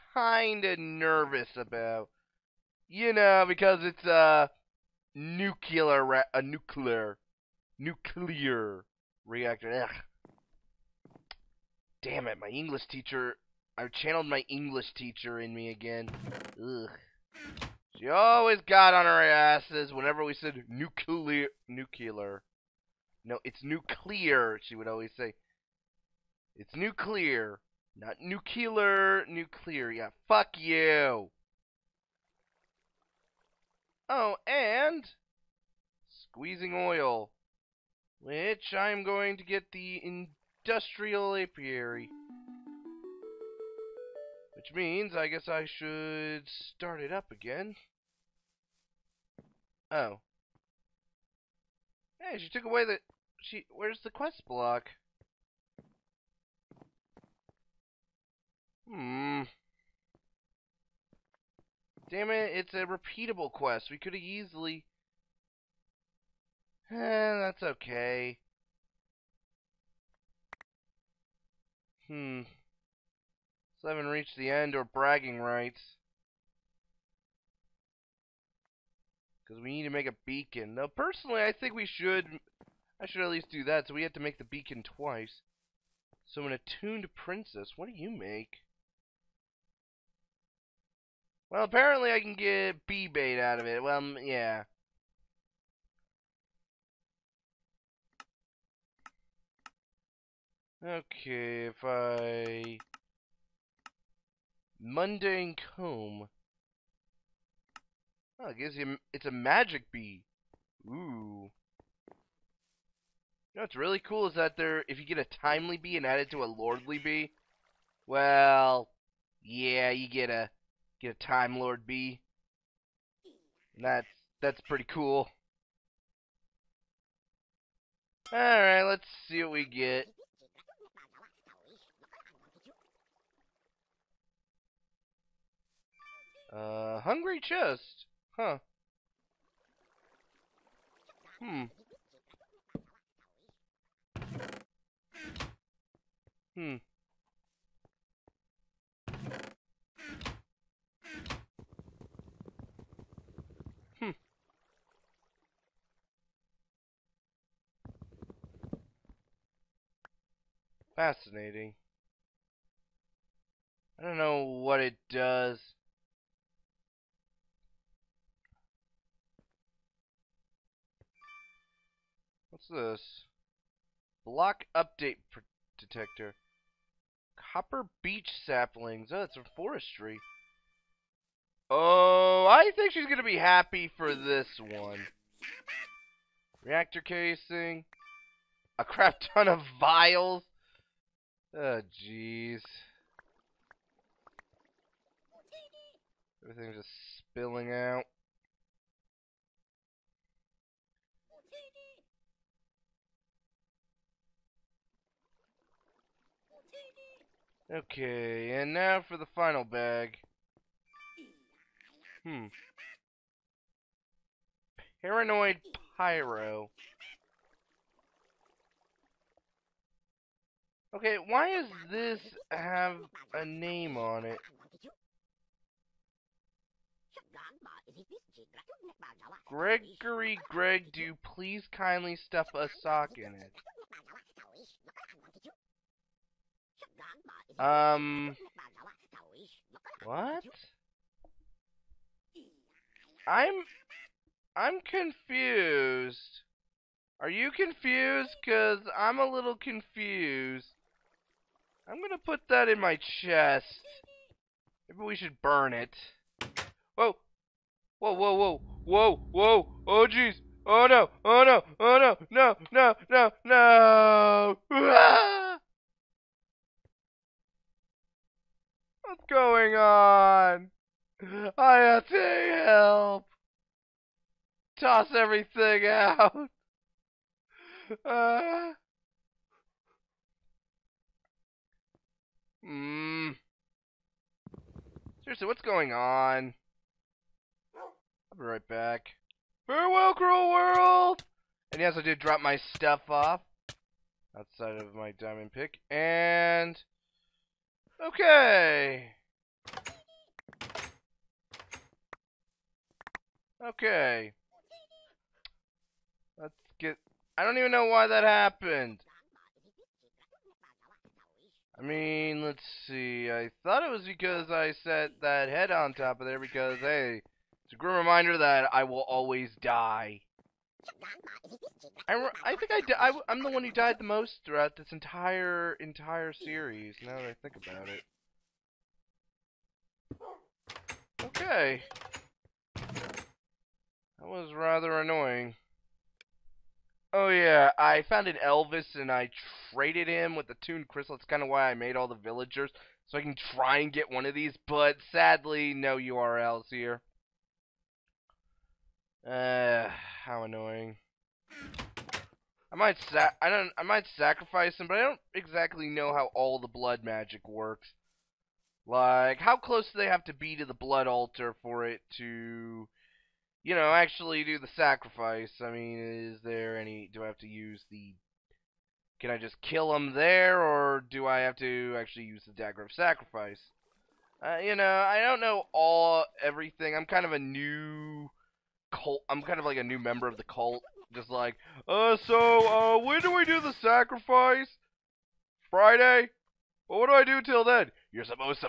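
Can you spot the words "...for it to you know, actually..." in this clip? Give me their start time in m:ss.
6:01.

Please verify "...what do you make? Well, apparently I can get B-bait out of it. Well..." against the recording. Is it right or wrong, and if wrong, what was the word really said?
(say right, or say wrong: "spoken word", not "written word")
right.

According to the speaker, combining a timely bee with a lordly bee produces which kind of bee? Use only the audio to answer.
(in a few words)
Time lord bee.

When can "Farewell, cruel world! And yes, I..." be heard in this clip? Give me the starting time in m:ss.
4:49.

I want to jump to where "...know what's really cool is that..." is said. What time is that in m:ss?
1:53.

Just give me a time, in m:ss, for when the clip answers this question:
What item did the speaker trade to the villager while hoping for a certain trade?
5:40.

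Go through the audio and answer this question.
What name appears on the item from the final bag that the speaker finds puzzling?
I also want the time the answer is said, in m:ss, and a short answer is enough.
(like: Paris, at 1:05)
Paranoid Pyro, at 3:35.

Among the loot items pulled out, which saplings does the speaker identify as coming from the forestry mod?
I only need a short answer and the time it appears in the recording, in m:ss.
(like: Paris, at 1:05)
Copper beech saplings, at 2:57.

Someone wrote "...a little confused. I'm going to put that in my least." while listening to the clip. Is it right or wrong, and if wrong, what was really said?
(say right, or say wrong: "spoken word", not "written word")
wrong: "chest", not "least".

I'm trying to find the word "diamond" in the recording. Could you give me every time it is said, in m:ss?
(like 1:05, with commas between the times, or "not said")
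4:55.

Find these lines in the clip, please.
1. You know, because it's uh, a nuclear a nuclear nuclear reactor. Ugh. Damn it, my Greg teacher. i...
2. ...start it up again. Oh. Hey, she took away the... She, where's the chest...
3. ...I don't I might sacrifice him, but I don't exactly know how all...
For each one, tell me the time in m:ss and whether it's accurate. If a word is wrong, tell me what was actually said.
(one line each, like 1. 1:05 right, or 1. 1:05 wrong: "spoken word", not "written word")
1. 0:02 wrong: "English", not "Greg"
2. 0:46 wrong: "quest", not "chest"
3. 5:53 right.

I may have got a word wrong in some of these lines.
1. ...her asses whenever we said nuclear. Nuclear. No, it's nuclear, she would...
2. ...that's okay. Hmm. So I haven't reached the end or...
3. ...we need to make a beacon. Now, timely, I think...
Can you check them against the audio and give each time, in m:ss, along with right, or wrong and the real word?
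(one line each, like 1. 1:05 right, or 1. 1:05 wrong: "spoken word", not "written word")
1. 0:19 right
2. 1:07 right
3. 1:19 wrong: "personally", not "timely".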